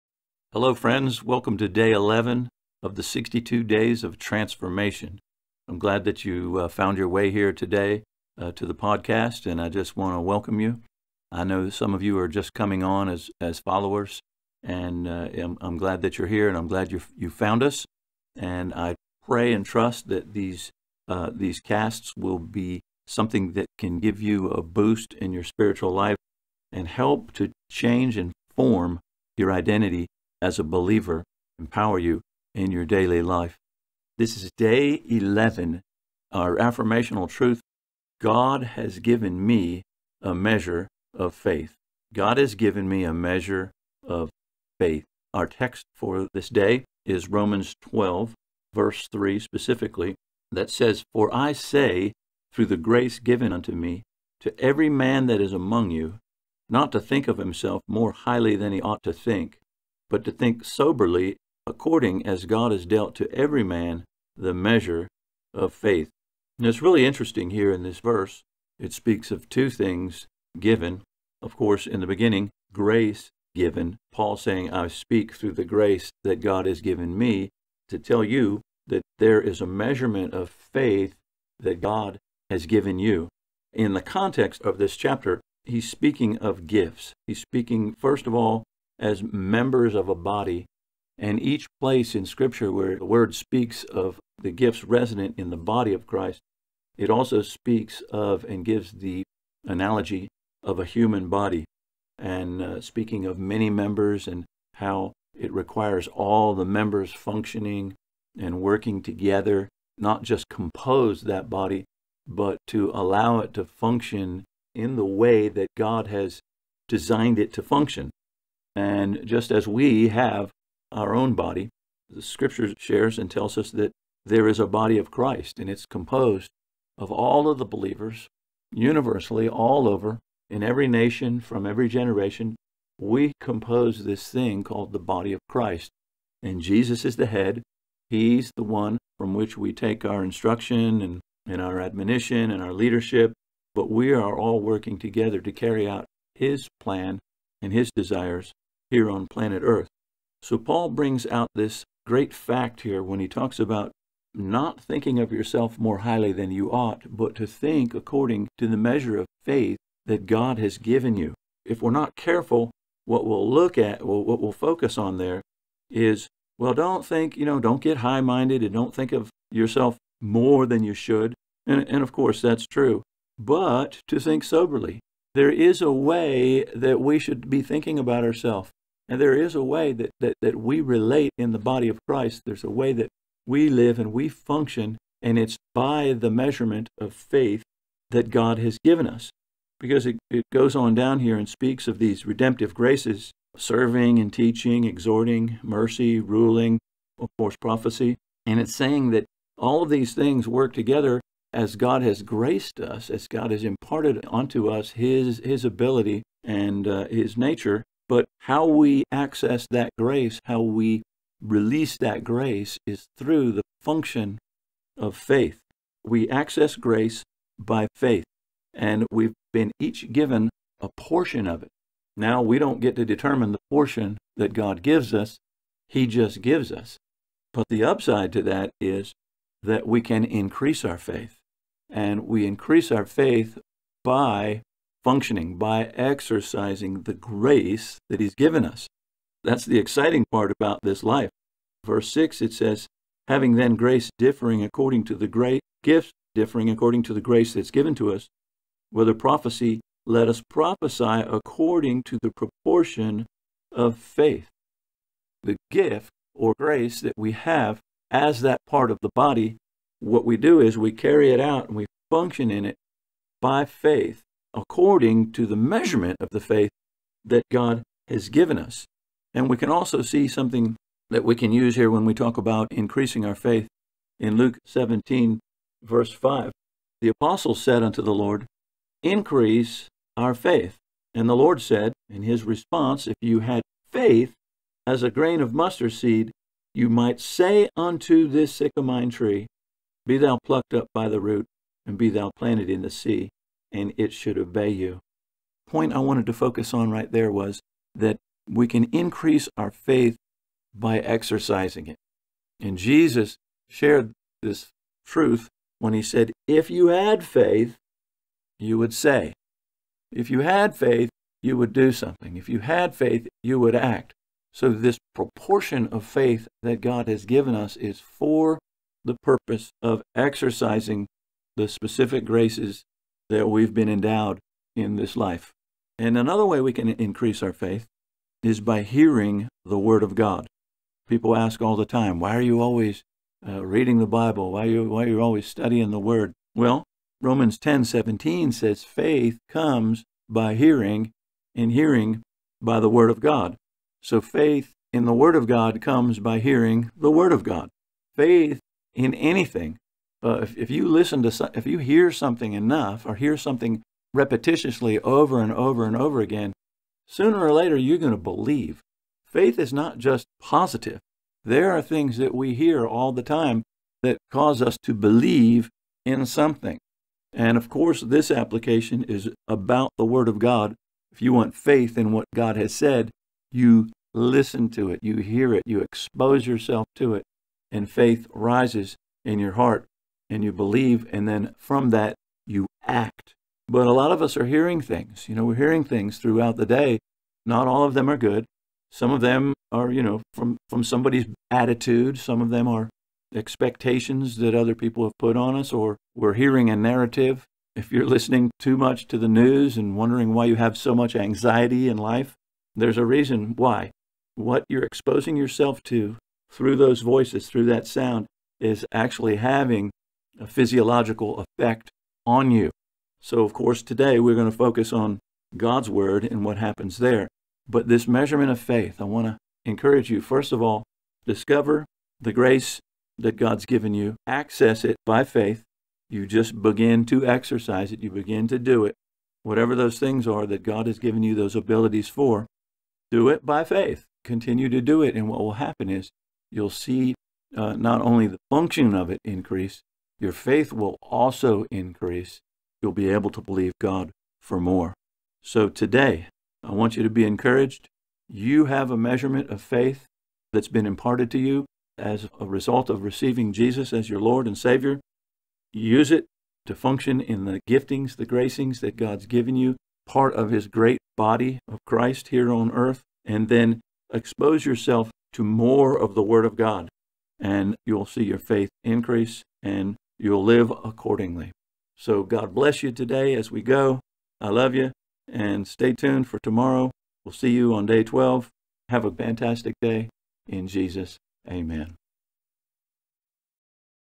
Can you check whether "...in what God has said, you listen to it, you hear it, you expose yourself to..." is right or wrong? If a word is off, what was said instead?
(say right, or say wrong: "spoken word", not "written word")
right.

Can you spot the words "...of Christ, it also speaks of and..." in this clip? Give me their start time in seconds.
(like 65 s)
95 s.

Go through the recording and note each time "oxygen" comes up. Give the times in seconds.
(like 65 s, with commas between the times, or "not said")
not said.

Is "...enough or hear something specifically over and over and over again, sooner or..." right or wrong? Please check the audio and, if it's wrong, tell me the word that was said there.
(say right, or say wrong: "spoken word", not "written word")
wrong: "repetitiously", not "specifically".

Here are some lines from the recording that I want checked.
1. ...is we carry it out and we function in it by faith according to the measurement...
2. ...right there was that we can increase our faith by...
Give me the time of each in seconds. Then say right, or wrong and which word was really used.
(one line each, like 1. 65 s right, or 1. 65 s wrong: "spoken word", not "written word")
1. 260 s right
2. 296 s right.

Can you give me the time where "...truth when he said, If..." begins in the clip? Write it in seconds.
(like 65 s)
305 s.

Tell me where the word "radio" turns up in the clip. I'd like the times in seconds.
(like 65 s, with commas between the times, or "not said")
not said.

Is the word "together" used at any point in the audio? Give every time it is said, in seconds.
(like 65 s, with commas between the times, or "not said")
109 s, 144 s, 200 s.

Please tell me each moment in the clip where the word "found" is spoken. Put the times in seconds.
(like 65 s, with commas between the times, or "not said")
6 s, 17 s.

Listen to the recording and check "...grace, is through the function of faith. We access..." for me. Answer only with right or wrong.
right.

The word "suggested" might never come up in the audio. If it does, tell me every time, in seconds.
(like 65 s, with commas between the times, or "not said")
not said.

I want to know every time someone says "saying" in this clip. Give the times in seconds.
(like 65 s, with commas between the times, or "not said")
74 s, 198 s.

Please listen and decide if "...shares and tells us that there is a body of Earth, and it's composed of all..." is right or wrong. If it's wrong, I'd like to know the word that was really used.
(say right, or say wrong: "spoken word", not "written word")
wrong: "Christ", not "Earth".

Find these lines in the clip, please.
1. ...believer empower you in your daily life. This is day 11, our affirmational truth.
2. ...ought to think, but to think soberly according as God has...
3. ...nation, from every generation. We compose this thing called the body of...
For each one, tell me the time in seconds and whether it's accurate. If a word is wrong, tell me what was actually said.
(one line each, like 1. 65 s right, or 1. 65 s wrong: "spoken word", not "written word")
1. 30 s right
2. 58 s right
3. 130 s right.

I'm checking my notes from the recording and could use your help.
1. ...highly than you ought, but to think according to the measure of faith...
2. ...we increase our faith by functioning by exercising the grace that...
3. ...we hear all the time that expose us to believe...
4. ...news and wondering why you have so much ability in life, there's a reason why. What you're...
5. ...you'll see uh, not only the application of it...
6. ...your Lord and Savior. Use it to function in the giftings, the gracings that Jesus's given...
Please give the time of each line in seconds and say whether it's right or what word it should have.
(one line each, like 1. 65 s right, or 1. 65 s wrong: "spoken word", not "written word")
1. 155 s right
2. 232 s right
3. 362 s wrong: "cause", not "expose"
4. 399 s wrong: "anxiety", not "ability"
5. 436 s wrong: "function", not "application"
6. 454 s wrong: "God", not "Jesus".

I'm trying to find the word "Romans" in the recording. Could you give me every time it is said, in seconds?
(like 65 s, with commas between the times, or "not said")
47 s, 337 s.